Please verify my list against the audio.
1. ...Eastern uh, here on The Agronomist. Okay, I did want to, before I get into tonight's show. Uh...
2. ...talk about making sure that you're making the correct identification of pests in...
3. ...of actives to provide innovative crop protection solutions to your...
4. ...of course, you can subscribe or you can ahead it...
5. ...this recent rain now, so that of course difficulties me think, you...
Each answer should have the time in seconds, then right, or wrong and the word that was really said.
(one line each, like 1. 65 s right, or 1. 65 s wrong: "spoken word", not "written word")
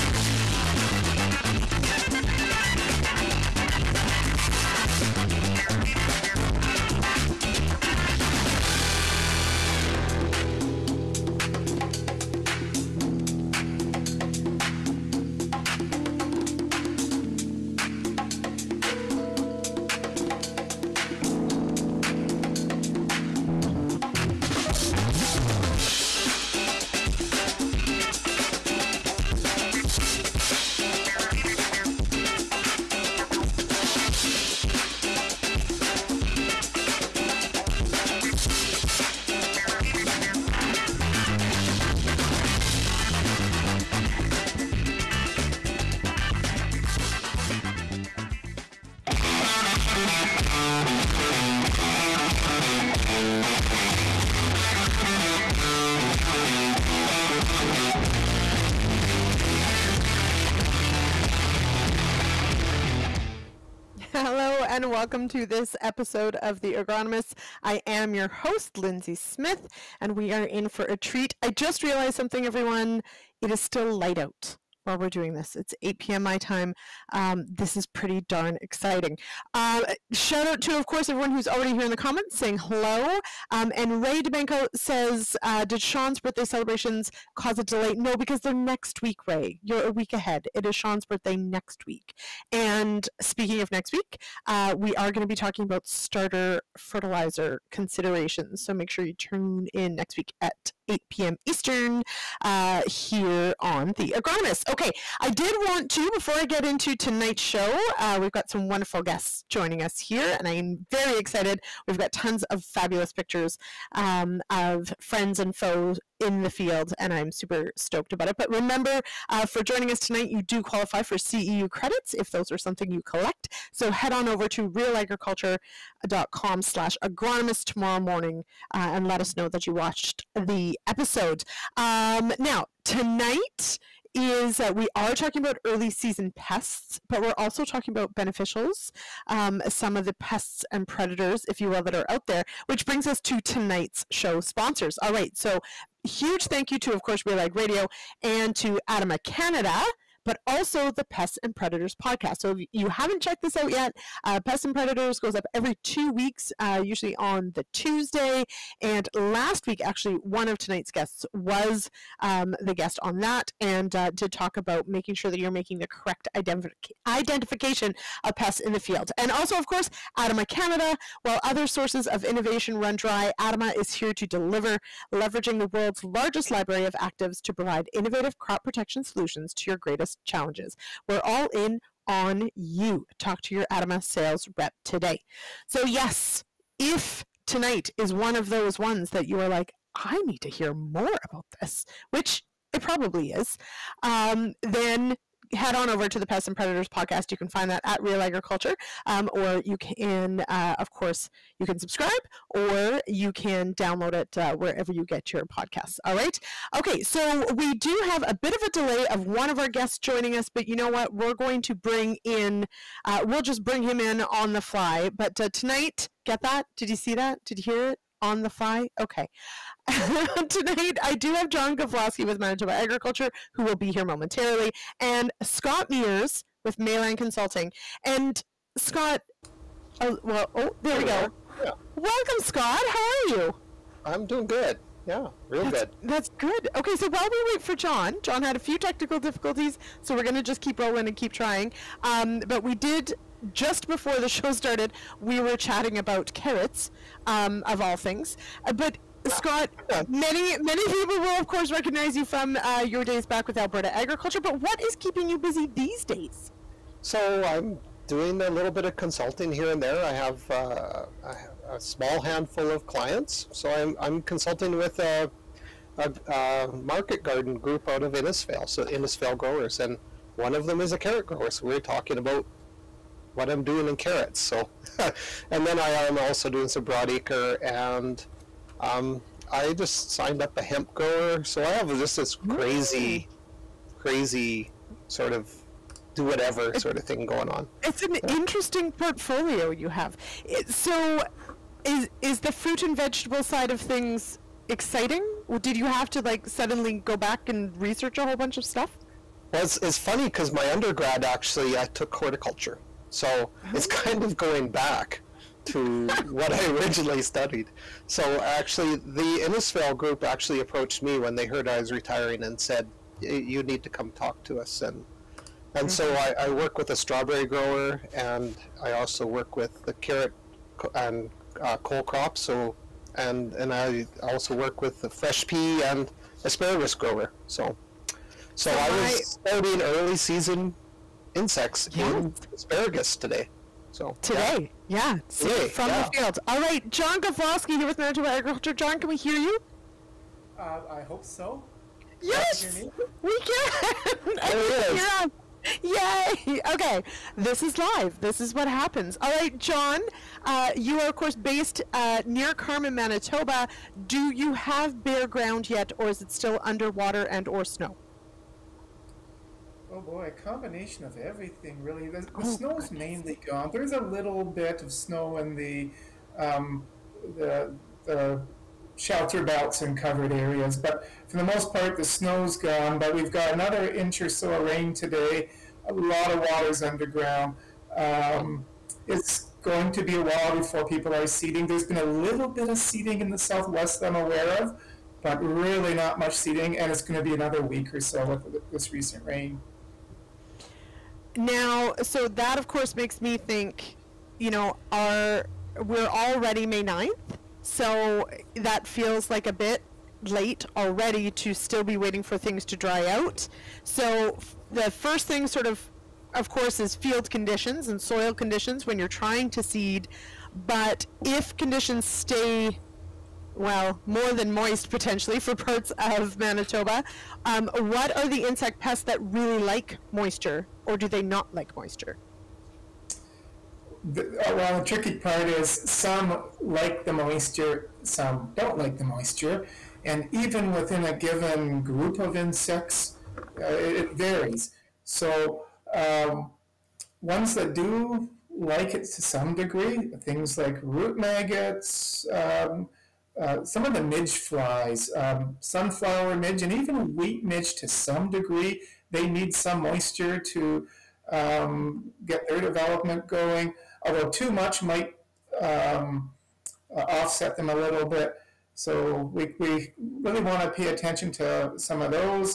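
1. 101 s right
2. 164 s right
3. 176 s right
4. 200 s wrong: "download", not "ahead"
5. 388 s wrong: "makes", not "difficulties".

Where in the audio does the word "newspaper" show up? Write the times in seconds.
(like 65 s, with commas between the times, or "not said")
not said.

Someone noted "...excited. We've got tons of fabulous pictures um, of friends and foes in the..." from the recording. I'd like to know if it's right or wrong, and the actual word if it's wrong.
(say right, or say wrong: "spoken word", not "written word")
right.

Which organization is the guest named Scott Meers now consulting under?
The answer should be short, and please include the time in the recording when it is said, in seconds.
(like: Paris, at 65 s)
Mayland Consulting, at 226 s.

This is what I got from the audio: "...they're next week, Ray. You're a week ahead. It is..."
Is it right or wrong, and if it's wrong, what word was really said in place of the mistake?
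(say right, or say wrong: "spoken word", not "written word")
right.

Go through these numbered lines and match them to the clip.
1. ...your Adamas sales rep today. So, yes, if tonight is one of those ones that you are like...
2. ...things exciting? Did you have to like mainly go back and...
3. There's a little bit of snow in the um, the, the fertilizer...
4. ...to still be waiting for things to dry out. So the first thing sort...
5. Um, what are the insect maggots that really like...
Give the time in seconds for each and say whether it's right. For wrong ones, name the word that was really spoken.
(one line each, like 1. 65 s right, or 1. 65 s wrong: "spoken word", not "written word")
1. 183 s right
2. 293 s wrong: "suddenly", not "mainly"
3. 363 s wrong: "shelter", not "fertilizer"
4. 401 s right
5. 417 s wrong: "pests", not "maggots".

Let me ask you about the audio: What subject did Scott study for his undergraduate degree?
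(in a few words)
horticulture.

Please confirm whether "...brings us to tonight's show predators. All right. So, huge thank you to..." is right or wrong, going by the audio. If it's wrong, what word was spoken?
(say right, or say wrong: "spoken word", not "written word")
wrong: "sponsors", not "predators".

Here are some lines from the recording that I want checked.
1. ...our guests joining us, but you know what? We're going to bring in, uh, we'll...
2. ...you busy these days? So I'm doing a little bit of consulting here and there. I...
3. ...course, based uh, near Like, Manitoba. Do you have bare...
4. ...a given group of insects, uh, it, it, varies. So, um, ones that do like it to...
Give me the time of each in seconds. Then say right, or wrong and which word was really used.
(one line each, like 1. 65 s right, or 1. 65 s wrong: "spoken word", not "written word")
1. 209 s right
2. 255 s right
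3. 351 s wrong: "Carman", not "Like"
4. 431 s right.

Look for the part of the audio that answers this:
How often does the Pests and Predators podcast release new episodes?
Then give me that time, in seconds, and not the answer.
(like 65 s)
155 s.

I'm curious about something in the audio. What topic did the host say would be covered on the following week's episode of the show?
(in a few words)
starter fertilizer considerations.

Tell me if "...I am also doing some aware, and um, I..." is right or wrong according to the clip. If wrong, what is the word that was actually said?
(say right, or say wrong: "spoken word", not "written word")
wrong: "broadacre", not "aware".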